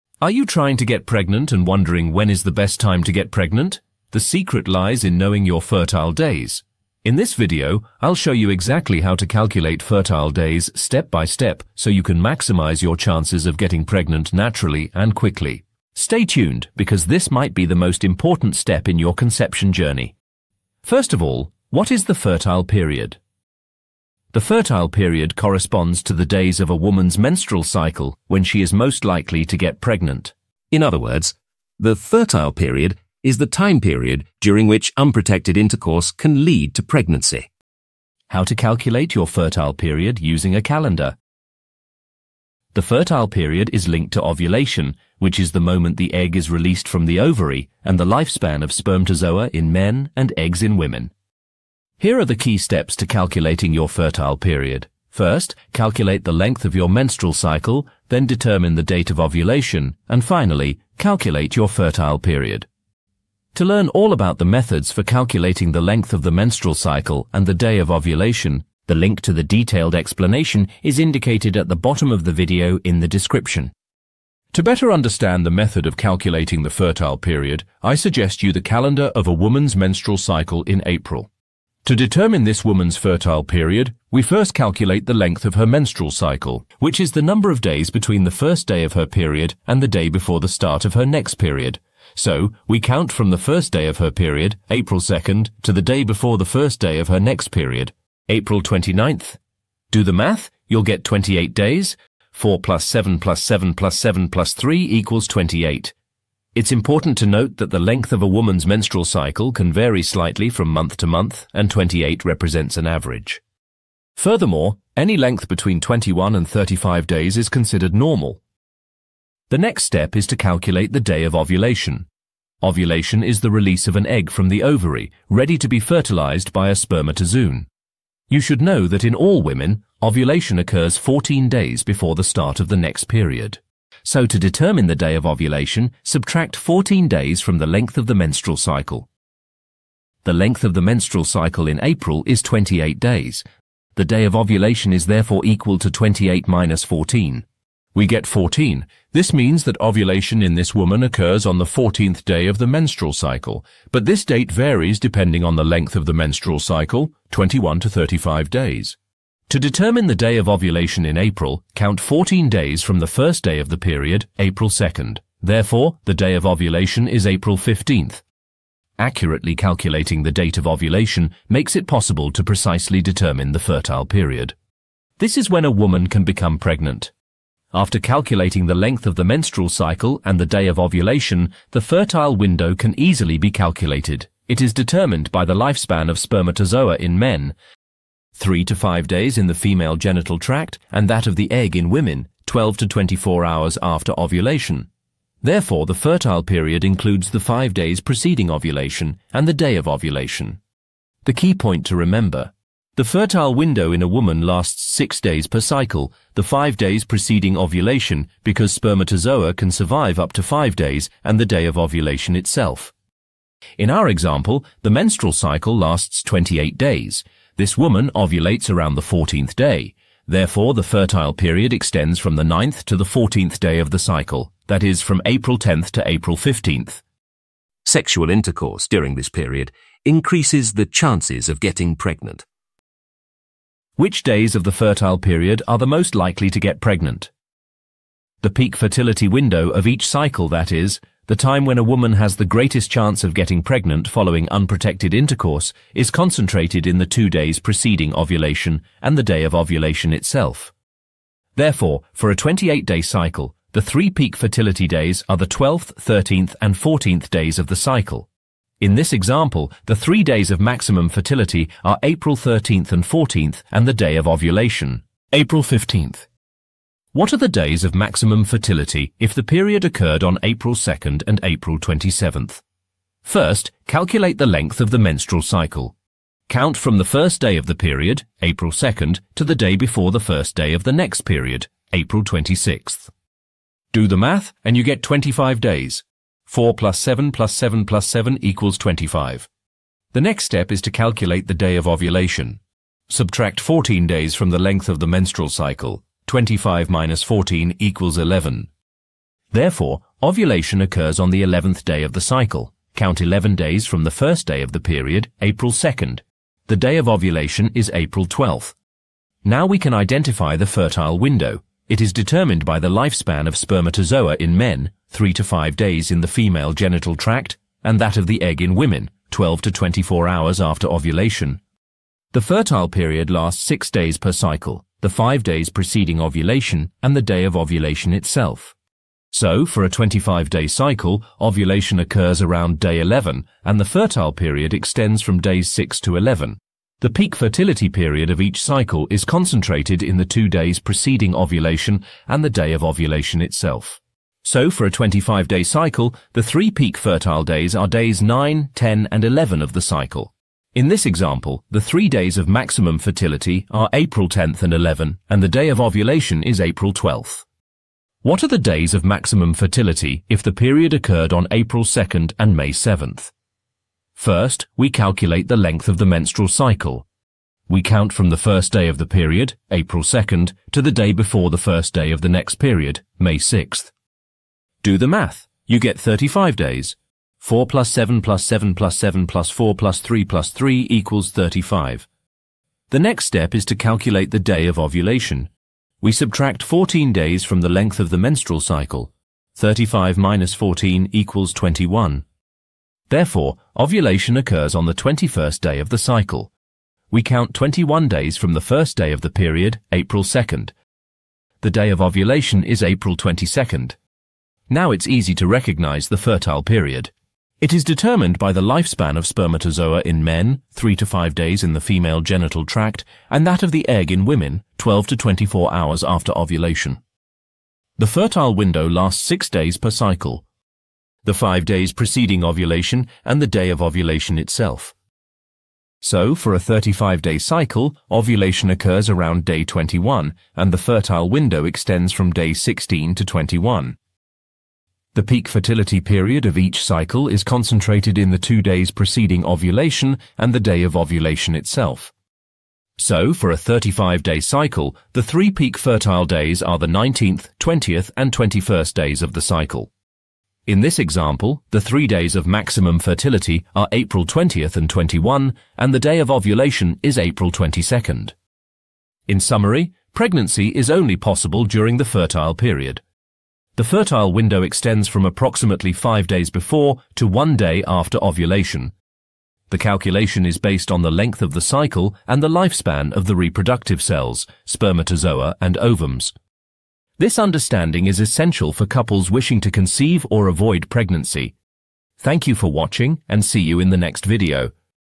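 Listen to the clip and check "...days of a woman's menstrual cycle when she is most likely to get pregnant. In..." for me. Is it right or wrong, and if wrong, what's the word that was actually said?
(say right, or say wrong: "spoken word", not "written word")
right.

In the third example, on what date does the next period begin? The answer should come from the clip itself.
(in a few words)
May 7th.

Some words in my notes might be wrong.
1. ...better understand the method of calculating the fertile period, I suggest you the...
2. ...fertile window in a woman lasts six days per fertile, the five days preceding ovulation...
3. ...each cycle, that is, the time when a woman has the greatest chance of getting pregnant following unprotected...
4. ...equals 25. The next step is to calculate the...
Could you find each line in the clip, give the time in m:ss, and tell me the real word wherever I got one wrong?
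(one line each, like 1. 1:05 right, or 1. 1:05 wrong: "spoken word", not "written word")
1. 1:14 right
2. 3:23 wrong: "cycle", not "fertile"
3. 3:59 right
4. 4:48 right.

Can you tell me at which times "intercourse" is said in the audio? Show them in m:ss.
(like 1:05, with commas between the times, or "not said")
0:35, 3:48, 4:05.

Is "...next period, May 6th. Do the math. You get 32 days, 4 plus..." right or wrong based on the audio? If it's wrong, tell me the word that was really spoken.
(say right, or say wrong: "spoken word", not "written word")
wrong: "35", not "32".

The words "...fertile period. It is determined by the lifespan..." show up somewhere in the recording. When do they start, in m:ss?
6:46.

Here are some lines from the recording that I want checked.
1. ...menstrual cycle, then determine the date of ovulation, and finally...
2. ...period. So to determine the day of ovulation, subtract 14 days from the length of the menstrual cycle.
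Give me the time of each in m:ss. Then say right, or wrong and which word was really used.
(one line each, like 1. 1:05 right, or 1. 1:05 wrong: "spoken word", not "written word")
1. 0:56 right
2. 2:13 right.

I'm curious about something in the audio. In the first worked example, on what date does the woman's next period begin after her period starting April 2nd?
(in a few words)
April 29th.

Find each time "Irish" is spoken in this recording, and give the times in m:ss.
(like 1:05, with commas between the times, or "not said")
not said.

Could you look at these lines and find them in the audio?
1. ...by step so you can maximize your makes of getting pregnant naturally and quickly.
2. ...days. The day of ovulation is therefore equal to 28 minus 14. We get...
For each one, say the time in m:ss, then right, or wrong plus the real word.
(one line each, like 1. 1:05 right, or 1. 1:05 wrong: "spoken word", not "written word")
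1. 0:11 wrong: "chances", not "makes"
2. 2:22 right.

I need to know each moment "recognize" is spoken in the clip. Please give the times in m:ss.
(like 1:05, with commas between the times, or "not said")
6:45.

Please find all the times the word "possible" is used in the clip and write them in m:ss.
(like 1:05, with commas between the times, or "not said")
2:51, 7:41.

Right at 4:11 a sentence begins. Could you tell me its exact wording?
Therefore, for a 28-day cycle, the three peak fertility days are the 12th, 13th, and 14th days of the cycle.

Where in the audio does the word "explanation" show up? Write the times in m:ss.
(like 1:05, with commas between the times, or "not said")
1:09.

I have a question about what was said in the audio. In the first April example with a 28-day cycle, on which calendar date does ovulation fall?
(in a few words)
April 15th.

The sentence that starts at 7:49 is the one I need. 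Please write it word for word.
The calculation is based on the length of the cycle and the lifespan of the reproductive cells, spermatozoa and ovums.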